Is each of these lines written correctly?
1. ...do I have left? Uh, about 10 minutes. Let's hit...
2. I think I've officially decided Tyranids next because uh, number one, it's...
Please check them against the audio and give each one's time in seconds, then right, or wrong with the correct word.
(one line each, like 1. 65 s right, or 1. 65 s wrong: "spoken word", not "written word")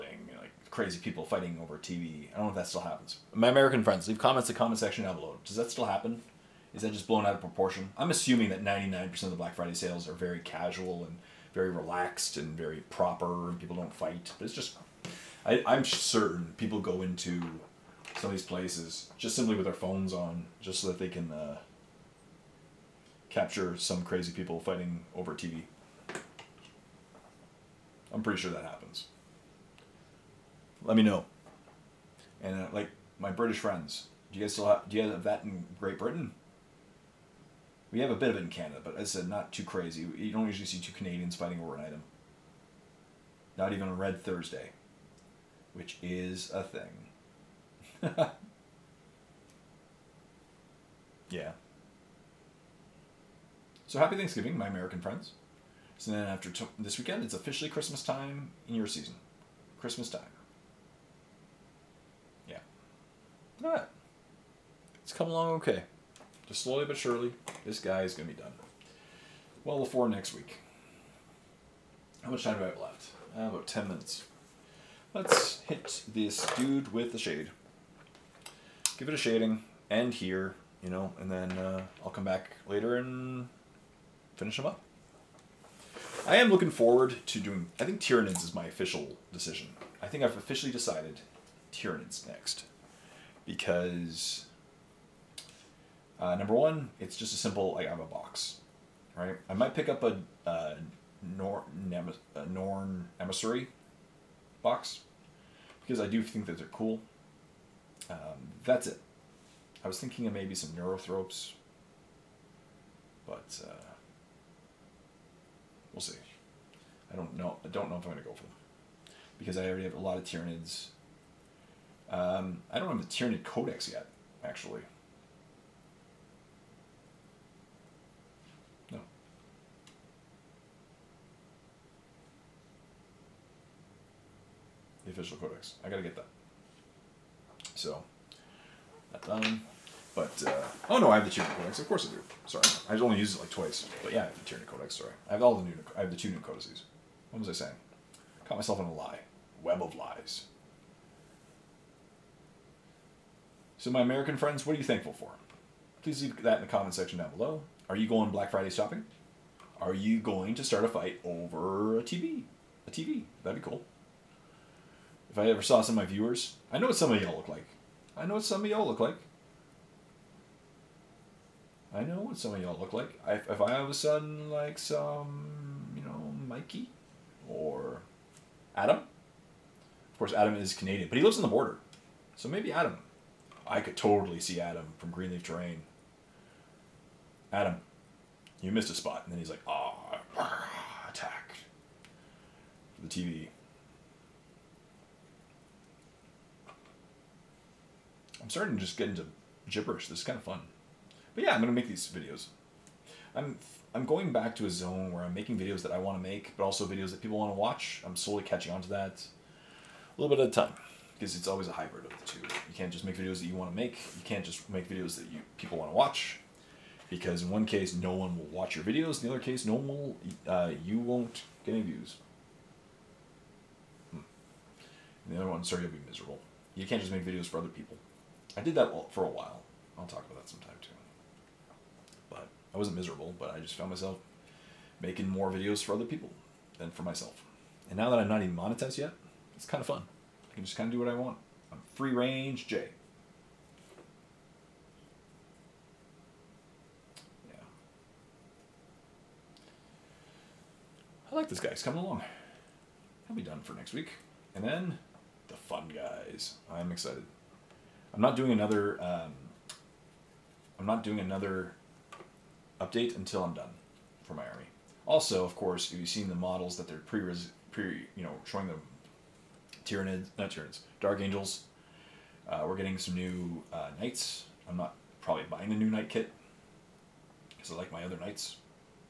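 1. 72 s right
2. 89 s right.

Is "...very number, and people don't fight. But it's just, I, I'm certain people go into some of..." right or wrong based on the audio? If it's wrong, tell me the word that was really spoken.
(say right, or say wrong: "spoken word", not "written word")
wrong: "proper", not "number".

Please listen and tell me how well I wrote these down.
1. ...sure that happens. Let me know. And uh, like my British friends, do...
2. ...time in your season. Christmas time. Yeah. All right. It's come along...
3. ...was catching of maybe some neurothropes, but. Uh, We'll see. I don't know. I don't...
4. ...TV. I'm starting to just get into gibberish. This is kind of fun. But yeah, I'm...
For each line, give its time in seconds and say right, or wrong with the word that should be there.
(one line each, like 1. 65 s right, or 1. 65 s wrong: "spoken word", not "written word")
1. 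28 s right
2. 58 s right
3. 109 s wrong: "thinking", not "catching"
4. 193 s right.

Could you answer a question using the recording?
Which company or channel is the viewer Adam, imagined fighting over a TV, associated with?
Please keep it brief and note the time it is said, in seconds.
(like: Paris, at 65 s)
Greenleaf Terrain, at 185 s.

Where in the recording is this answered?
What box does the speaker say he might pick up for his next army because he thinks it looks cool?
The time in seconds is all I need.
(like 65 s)
102 s.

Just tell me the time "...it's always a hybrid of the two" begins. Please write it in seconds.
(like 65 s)
211 s.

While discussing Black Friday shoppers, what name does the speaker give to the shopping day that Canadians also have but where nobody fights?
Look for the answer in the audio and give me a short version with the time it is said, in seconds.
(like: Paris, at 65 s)
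Red Thursday, at 43 s.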